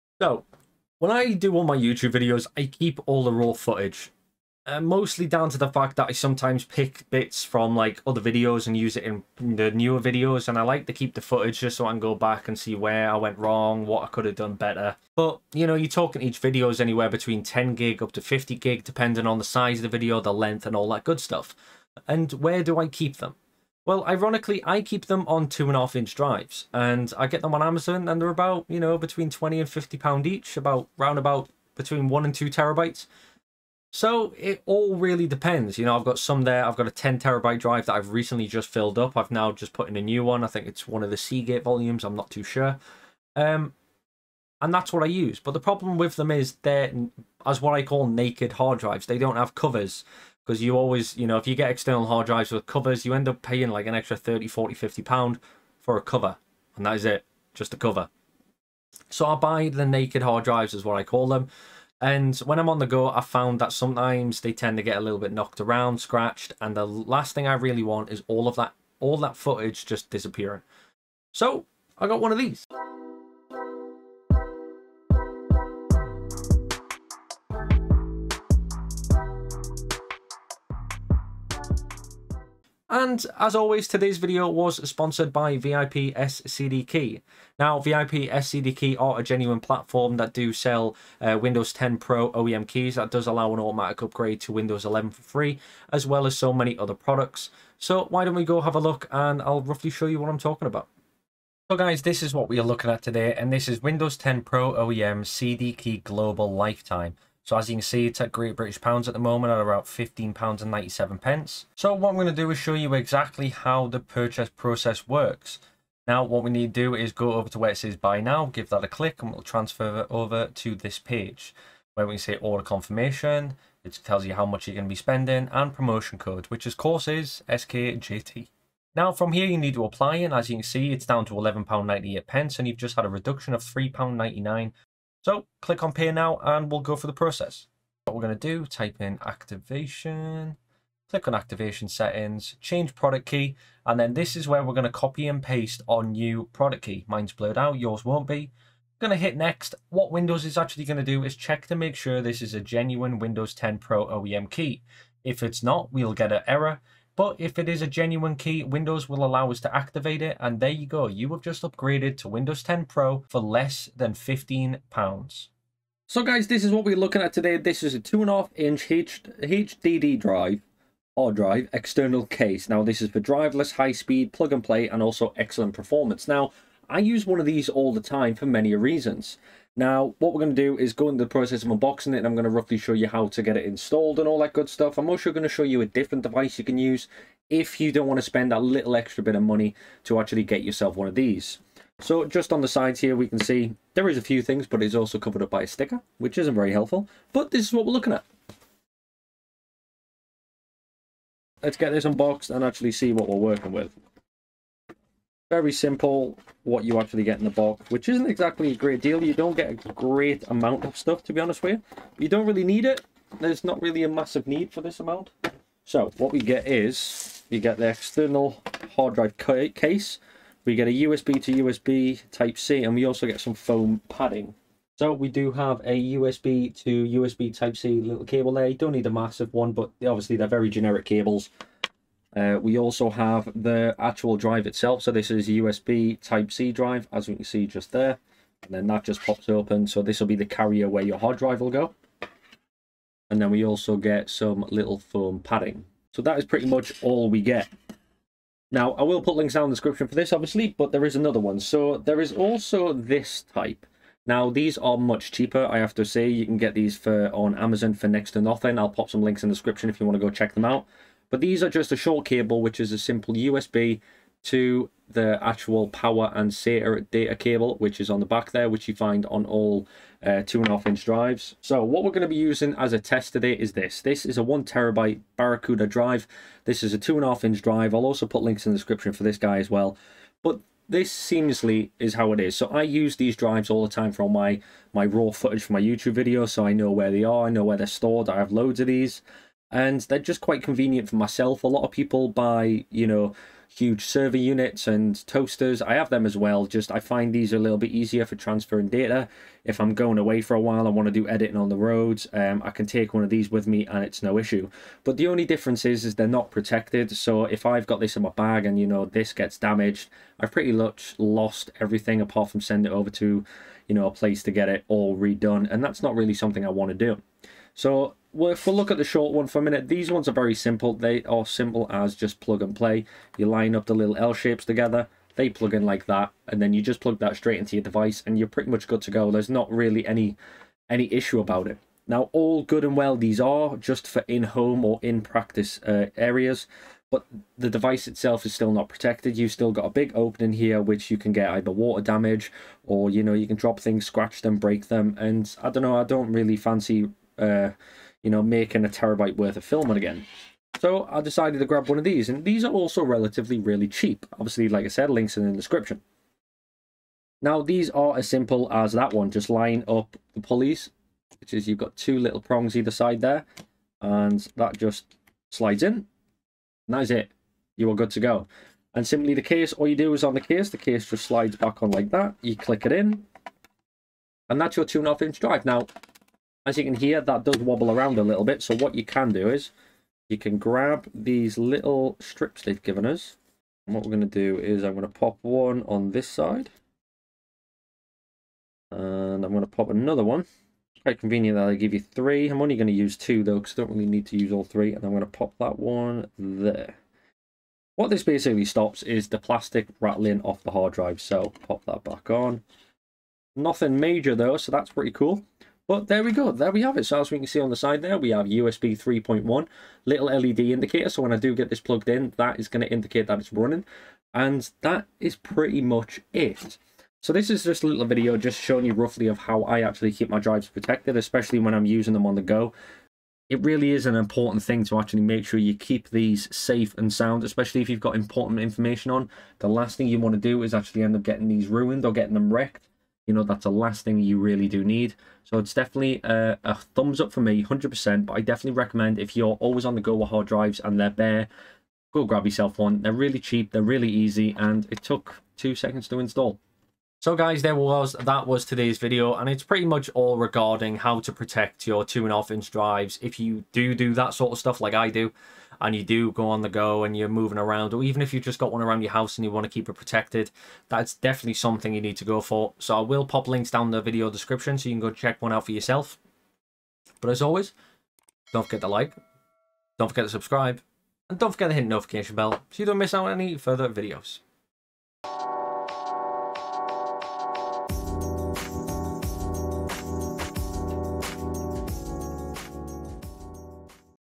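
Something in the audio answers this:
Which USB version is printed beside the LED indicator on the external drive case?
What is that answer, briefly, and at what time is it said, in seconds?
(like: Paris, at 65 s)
USB 3.1, at 408 s.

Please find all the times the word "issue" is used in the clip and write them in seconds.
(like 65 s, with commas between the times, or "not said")
304 s, 331 s.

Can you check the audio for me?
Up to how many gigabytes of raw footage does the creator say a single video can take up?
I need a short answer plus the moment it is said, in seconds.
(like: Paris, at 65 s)
50 gig, at 18 s.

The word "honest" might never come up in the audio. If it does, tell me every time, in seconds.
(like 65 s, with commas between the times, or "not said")
211 s.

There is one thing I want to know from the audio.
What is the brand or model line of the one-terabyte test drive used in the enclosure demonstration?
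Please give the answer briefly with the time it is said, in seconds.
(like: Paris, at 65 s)
Barracuda, at 275 s.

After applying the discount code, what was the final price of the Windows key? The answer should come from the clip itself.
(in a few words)
£11.98.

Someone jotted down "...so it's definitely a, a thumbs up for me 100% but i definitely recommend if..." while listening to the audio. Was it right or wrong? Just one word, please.
right.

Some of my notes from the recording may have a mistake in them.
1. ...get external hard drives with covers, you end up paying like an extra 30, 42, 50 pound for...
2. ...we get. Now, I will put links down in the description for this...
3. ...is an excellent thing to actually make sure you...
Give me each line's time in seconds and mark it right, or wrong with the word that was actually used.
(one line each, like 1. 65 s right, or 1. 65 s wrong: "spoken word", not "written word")
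1. 51 s wrong: "40", not "42"
2. 247 s right
3. 423 s wrong: "important", not "excellent".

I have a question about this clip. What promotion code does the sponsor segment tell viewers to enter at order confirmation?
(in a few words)
SKJT.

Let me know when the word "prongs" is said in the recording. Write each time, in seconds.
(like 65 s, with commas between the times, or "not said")
362 s.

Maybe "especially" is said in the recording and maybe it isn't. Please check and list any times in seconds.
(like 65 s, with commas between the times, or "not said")
421 s, 427 s.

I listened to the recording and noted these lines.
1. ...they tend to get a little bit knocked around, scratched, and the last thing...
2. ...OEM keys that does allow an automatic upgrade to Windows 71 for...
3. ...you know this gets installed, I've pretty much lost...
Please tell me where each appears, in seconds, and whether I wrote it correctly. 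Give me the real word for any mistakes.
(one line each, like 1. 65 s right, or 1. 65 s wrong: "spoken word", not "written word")
1. 64 s right
2. 92 s wrong: "11", not "71"
3. 308 s wrong: "damaged", not "installed".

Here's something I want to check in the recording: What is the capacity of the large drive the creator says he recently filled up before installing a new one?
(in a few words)
10 terabyte.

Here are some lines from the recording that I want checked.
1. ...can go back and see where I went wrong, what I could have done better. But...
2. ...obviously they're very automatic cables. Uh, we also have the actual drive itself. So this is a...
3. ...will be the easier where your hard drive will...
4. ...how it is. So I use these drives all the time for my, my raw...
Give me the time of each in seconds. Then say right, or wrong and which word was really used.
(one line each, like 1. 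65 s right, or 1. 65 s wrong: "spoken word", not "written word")
1. 11 s right
2. 230 s wrong: "generic", not "automatic"
3. 240 s wrong: "carrier", not "easier"
4. 282 s right.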